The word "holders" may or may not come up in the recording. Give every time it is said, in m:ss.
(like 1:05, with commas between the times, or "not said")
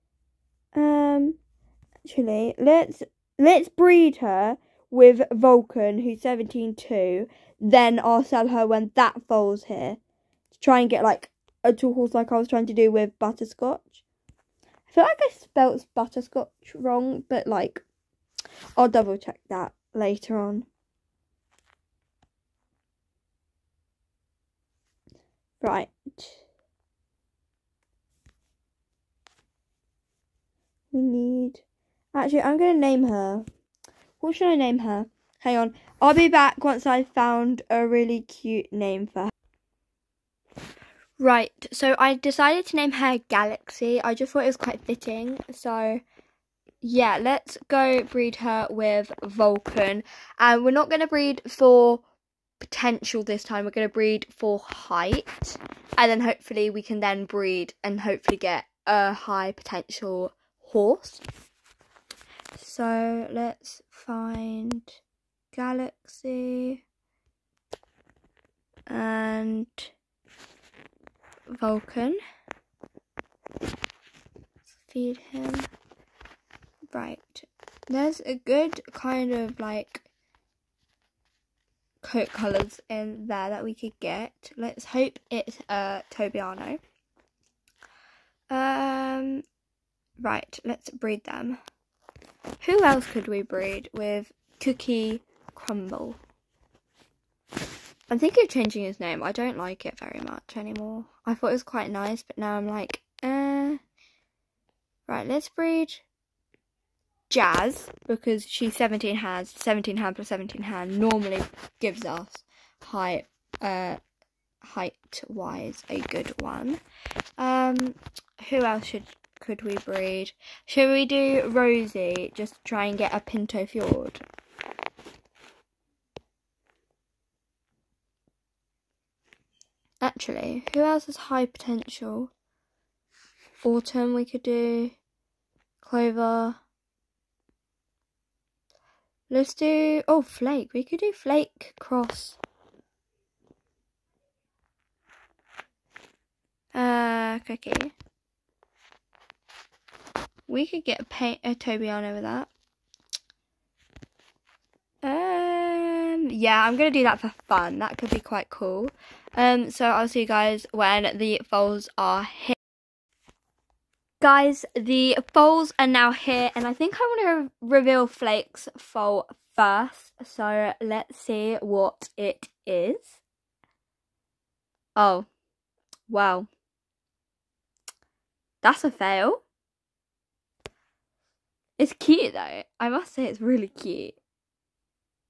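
not said.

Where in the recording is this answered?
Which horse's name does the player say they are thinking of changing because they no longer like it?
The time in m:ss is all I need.
1:34.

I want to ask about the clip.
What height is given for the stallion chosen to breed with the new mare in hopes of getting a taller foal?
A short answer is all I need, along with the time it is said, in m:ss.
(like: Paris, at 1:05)
17.2, at 0:06.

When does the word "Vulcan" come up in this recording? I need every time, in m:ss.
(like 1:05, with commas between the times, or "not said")
0:05, 0:49, 1:11.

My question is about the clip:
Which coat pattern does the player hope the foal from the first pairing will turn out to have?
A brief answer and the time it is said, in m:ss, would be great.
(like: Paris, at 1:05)
Tobiano, at 1:26.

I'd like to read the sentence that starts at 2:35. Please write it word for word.
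Um, yeah, I'm going to do that for fun.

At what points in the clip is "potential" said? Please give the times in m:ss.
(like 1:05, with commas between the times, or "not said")
0:52, 0:59, 2:11.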